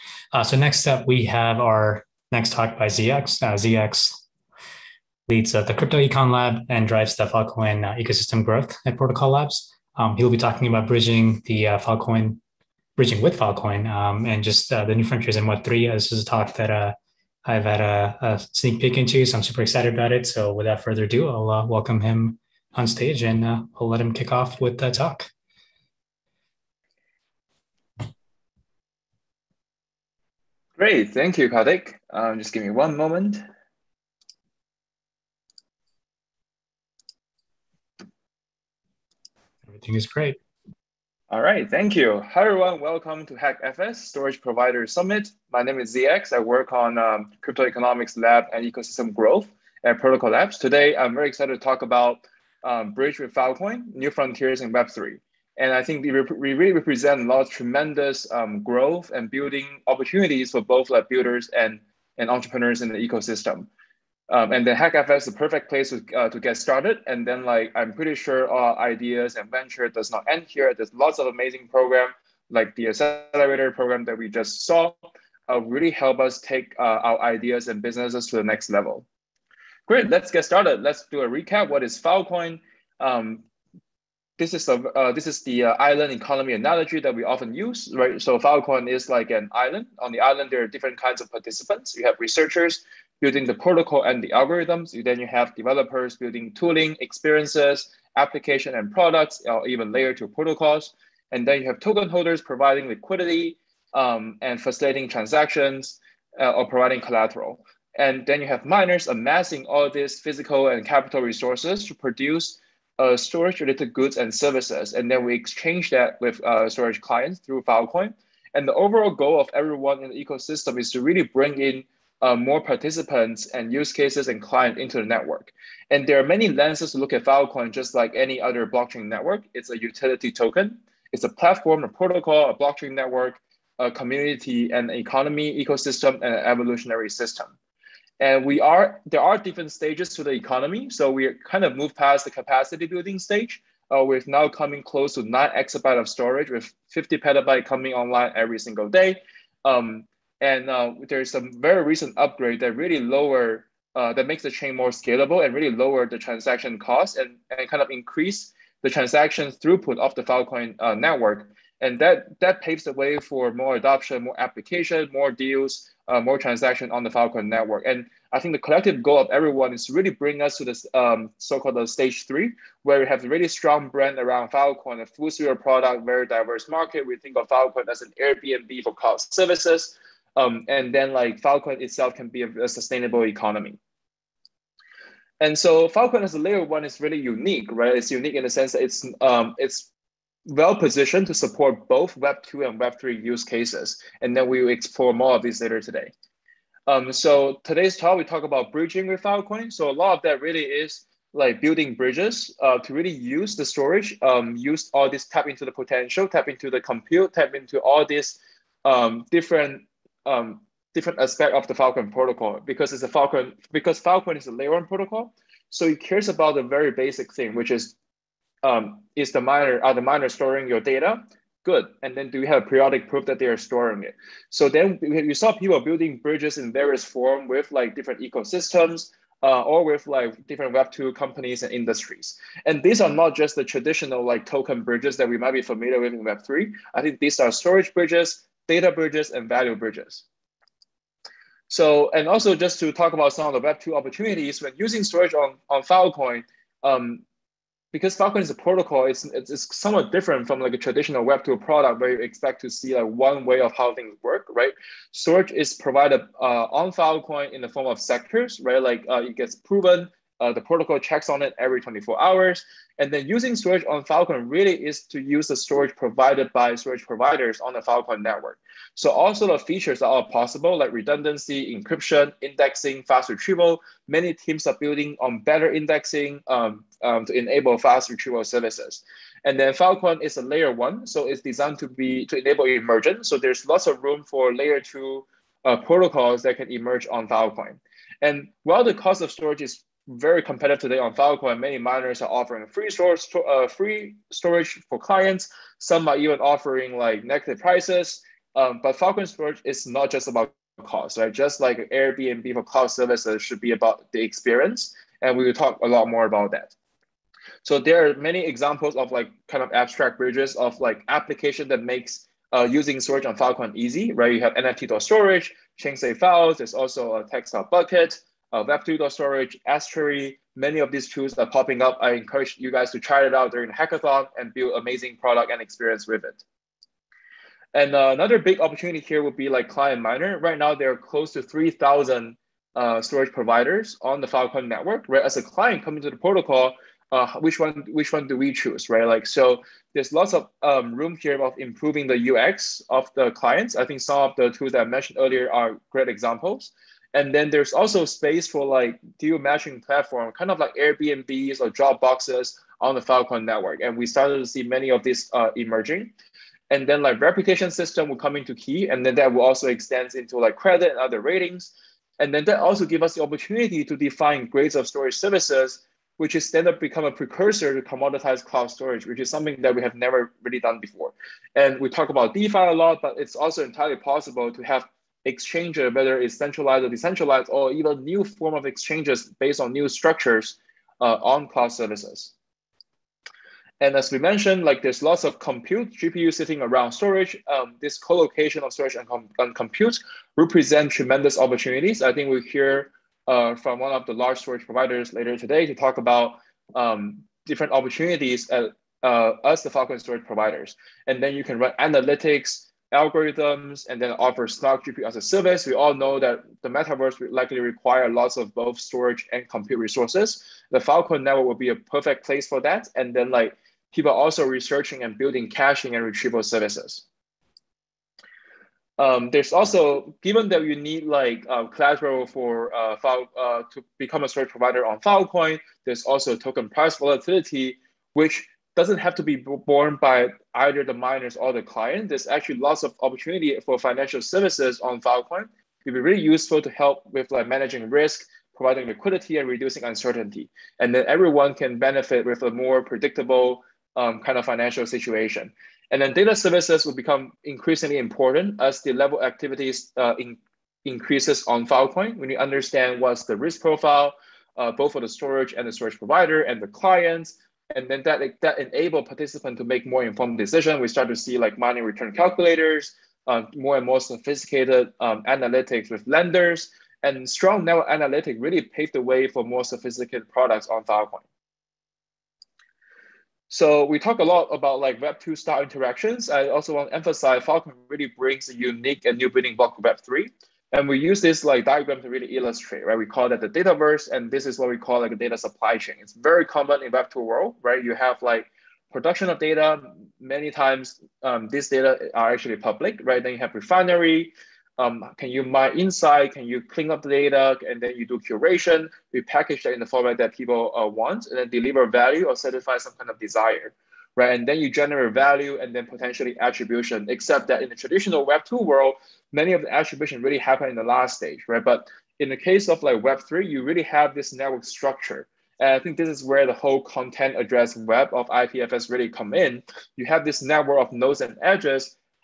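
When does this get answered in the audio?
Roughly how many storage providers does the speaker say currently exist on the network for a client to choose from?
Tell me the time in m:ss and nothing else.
5:31.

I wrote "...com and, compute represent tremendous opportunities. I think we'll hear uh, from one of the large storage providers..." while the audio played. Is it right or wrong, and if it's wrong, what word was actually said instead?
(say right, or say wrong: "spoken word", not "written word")
right.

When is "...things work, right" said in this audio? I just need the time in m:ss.
4:13.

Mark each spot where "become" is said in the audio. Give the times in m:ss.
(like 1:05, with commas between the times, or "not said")
6:06, 7:03, 7:26.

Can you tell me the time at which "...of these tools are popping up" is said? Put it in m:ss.
5:20.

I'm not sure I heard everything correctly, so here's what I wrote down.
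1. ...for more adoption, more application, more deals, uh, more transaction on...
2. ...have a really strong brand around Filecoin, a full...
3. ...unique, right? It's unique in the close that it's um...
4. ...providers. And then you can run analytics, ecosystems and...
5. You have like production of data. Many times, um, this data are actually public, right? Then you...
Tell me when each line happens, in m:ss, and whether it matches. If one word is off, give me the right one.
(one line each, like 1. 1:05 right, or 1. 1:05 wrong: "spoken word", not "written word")
1. 2:43 right
2. 2:53 right
3. 3:07 wrong: "sense", not "close"
4. 6:40 wrong: "algorithms", not "ecosystems"
5. 8:07 right.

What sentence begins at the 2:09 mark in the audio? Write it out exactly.
It's a utility token, it's a platform, a protocol, a blockchain network, a community, an economy, ecosystem, and an evolutionary system.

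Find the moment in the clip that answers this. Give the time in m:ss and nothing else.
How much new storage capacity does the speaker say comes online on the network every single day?
2:26.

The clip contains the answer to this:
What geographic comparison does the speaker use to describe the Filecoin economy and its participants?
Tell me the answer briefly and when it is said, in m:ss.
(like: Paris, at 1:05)
island economy, at 1:25.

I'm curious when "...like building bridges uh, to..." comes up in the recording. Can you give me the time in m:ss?
3:21.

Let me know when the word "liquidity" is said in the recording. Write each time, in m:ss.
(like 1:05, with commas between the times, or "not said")
1:42, 7:18.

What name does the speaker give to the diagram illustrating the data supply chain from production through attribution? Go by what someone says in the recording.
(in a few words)
dataverse.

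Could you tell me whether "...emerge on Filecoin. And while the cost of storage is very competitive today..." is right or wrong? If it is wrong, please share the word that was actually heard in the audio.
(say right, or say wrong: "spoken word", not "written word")
right.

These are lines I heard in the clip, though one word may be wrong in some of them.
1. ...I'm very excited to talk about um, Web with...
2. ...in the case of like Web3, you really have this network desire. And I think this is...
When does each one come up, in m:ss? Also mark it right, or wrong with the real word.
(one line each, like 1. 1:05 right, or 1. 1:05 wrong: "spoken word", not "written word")
1. 0:50 wrong: "Bridge", not "Web"
2. 8:32 wrong: "structure", not "desire".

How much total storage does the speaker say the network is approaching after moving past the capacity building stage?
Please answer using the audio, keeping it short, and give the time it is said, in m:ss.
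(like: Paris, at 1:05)
nine exabyte, at 2:25.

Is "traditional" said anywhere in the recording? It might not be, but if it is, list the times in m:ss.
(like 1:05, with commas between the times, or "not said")
3:53, 4:10, 8:27.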